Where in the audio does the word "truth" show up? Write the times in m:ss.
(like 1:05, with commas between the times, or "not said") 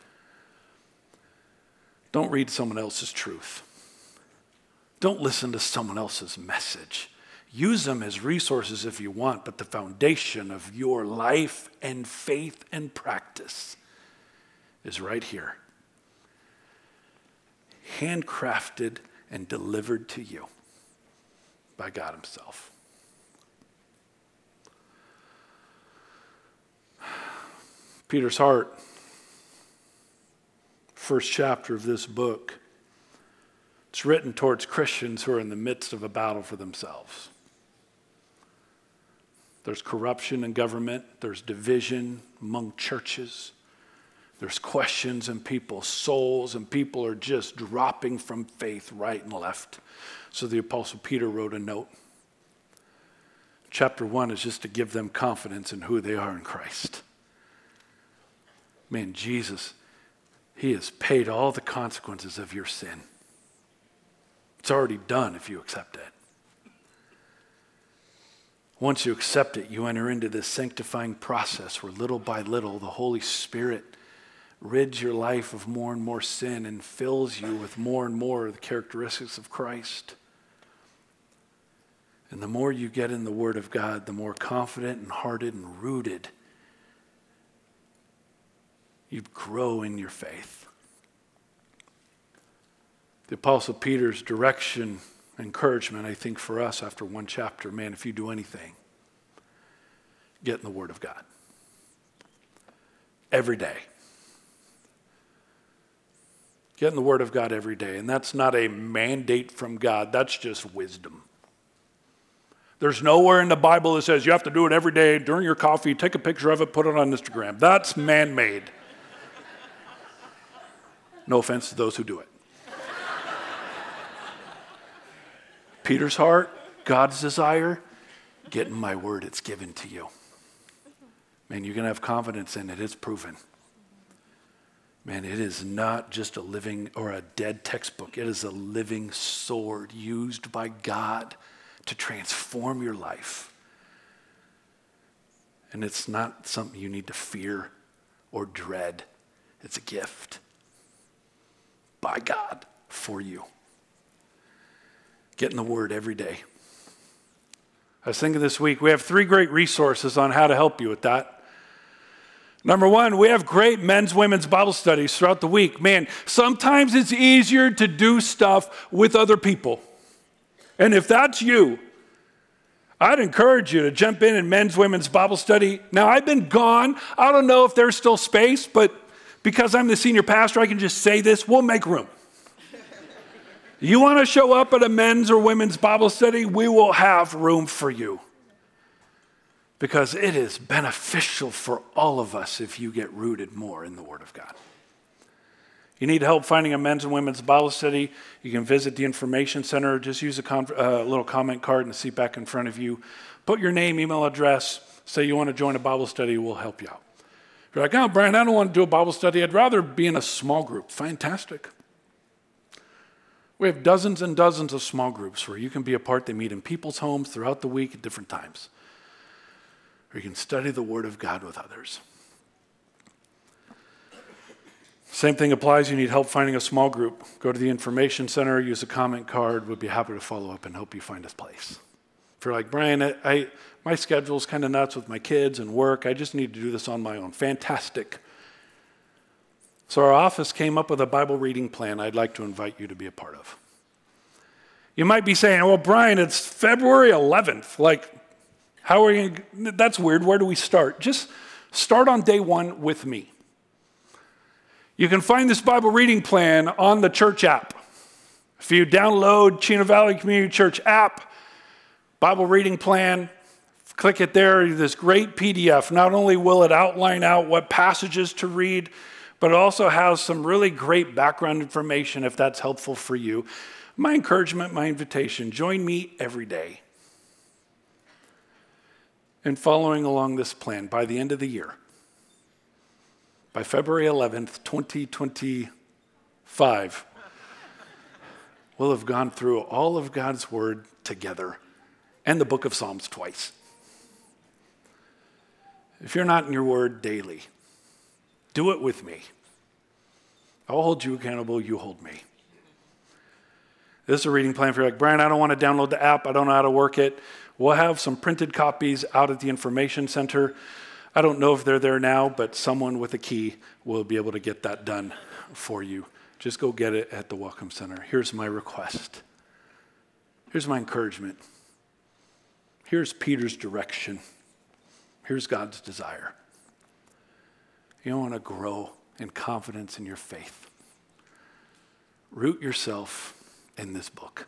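0:03.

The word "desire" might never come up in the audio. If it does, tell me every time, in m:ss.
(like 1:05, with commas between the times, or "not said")
2:07, 5:25.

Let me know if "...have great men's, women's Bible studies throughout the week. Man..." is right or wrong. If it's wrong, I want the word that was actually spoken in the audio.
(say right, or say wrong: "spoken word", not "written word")
right.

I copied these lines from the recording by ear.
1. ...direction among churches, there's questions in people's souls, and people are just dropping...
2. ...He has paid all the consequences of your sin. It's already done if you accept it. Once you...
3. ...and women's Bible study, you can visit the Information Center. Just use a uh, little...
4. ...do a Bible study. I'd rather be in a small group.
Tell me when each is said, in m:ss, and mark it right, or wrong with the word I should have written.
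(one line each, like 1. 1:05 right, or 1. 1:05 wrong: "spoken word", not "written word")
1. 0:41 wrong: "division", not "direction"
2. 1:00 right
3. 3:17 right
4. 3:28 right.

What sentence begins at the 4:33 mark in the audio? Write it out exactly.
My encouragement, my invitation join me every day in following along this plan by the end of the year.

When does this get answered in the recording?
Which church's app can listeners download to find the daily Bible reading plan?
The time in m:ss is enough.
4:19.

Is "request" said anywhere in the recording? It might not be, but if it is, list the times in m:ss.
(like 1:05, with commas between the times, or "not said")
5:18.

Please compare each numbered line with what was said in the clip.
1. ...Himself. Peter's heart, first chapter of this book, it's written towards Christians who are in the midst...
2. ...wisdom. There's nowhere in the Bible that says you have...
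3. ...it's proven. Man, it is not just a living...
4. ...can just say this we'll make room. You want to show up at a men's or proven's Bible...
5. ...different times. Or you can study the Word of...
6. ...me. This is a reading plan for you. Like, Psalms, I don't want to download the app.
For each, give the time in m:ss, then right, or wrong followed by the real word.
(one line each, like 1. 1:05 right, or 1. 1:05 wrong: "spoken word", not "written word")
1. 0:22 right
2. 1:50 right
3. 2:12 right
4. 3:00 wrong: "women", not "proven"
5. 3:38 right
6. 5:02 wrong: "Brian", not "Psalms".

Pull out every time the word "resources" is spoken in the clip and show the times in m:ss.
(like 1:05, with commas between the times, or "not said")
0:08, 2:39.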